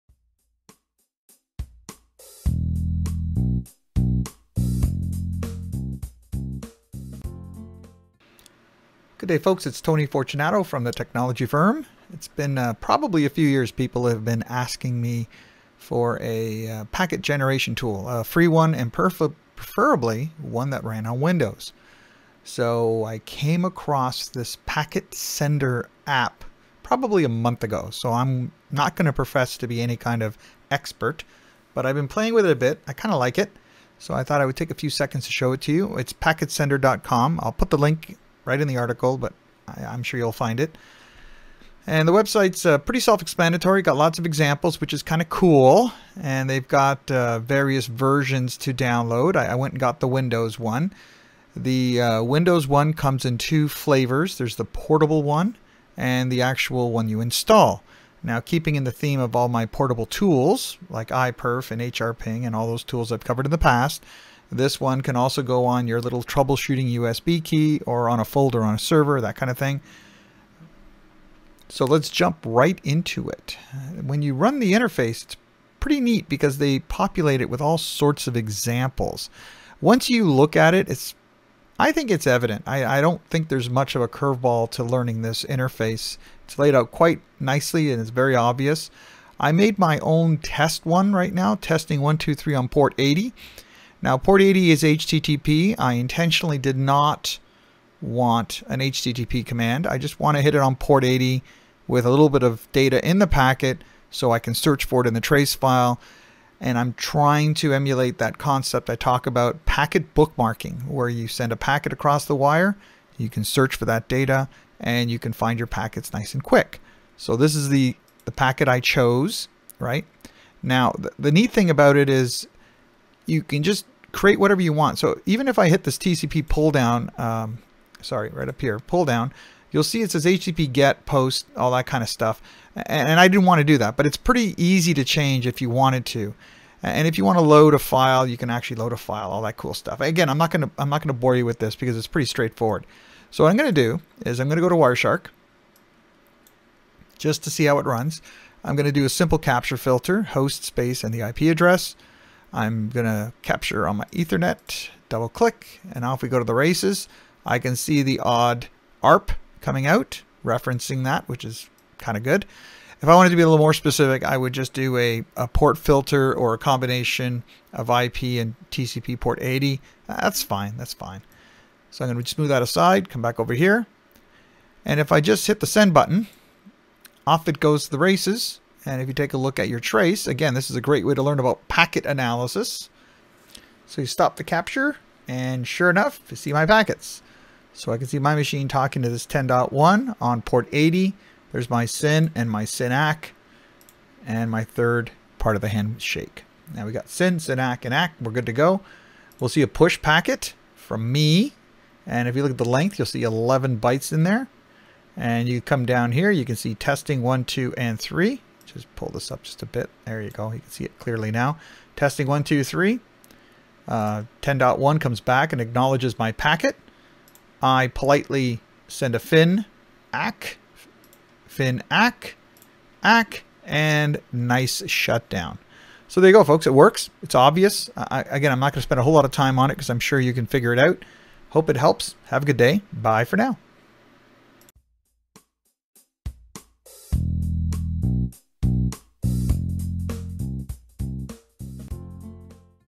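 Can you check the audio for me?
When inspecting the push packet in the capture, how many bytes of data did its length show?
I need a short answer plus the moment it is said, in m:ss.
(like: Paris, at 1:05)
11, at 3:23.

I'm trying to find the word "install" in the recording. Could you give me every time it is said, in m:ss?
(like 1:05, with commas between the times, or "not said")
0:57.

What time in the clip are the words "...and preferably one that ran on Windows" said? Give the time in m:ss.
0:18.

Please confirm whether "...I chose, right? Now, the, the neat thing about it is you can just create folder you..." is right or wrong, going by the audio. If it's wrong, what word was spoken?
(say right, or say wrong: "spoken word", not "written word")
wrong: "whatever", not "folder".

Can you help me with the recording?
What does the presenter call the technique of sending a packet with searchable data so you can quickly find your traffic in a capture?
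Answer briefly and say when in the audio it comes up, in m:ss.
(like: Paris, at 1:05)
Packet bookmarking, at 1:49.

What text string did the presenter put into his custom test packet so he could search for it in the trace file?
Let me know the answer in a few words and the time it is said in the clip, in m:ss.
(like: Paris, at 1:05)
testing 123, at 1:31.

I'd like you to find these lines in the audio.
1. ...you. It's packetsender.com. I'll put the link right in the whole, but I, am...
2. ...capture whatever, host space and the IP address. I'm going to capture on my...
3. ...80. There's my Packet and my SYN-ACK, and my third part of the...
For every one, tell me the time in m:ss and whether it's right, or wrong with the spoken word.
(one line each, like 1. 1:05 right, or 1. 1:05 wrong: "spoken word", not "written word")
1. 0:35 wrong: "article", not "whole"
2. 2:29 wrong: "filter", not "whatever"
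3. 3:10 wrong: "SYN", not "Packet".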